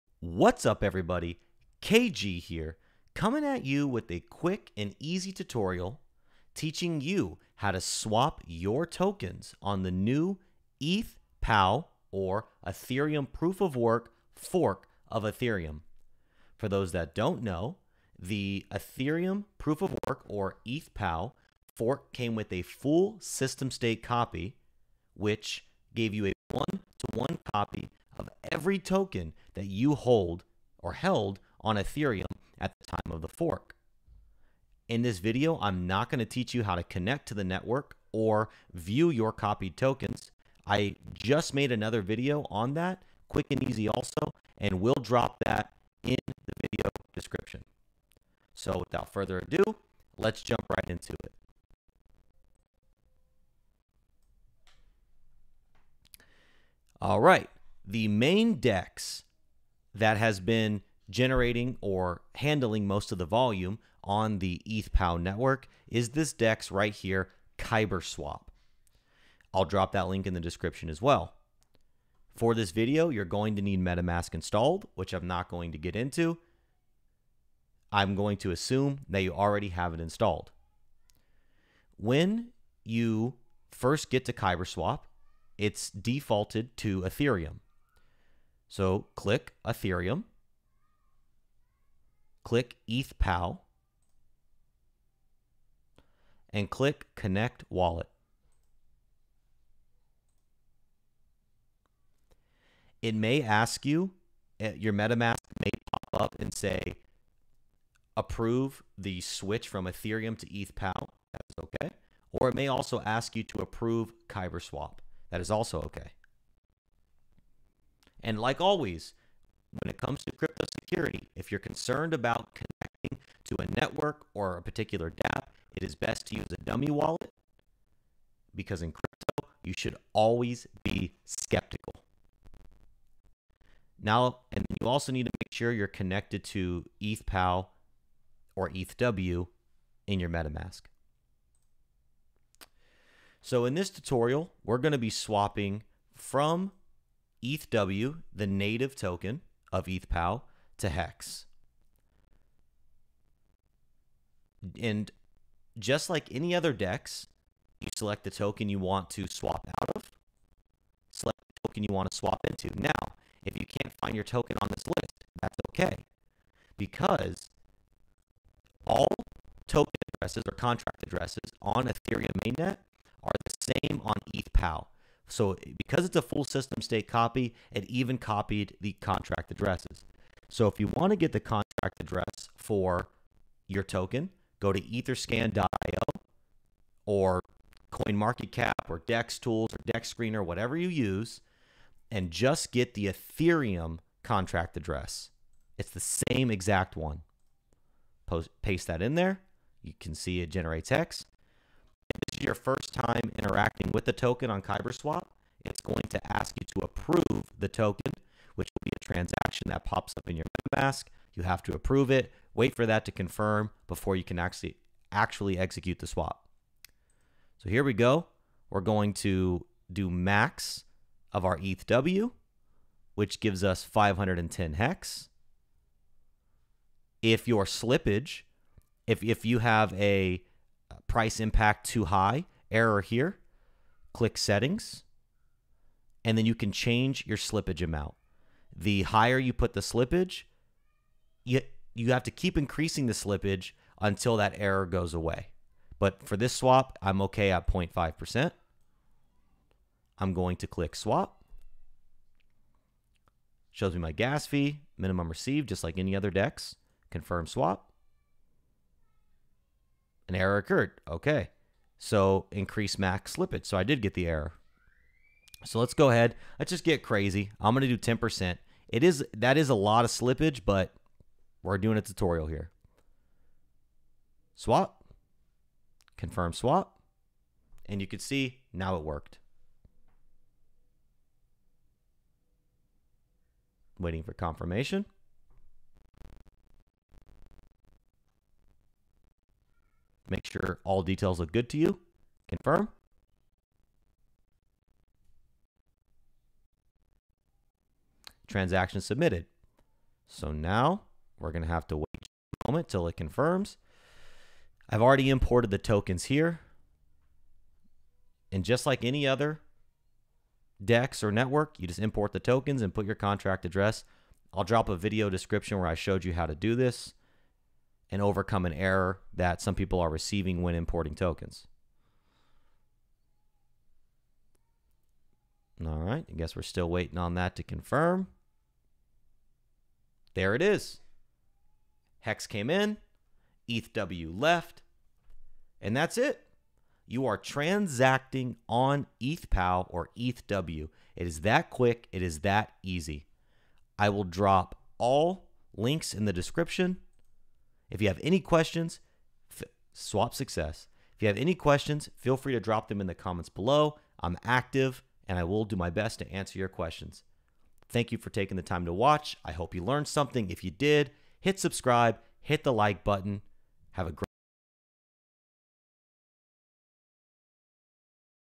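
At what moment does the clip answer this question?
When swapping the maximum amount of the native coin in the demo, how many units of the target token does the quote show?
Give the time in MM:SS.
03:43.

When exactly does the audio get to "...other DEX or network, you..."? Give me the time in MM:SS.
05:09.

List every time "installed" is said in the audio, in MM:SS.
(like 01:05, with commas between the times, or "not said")
01:14, 01:19.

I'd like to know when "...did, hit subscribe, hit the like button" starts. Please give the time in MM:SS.
06:00.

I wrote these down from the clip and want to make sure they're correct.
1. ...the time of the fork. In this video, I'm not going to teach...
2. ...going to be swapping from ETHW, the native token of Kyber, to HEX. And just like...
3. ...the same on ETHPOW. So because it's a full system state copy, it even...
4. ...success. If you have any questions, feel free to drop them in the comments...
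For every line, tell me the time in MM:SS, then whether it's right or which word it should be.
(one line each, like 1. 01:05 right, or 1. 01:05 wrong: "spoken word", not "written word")
1. 00:32 right
2. 02:24 wrong: "ETHPOW", not "Kyber"
3. 02:53 right
4. 05:50 right.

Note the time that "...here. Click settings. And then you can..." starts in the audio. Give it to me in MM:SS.
03:53.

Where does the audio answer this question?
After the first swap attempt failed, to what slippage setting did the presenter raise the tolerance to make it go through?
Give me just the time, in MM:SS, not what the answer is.
04:28.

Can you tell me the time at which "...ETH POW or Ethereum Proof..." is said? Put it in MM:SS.
00:10.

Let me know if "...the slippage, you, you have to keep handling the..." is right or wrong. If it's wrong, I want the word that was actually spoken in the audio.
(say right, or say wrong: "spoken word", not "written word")
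wrong: "increasing", not "handling".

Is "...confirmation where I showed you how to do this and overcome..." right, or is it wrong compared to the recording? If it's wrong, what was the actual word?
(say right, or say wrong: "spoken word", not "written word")
wrong: "description", not "confirmation".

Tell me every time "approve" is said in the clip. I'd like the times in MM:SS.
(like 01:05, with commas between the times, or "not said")
01:48, 01:53, 03:26, 03:31.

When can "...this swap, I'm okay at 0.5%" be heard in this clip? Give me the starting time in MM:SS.
04:06.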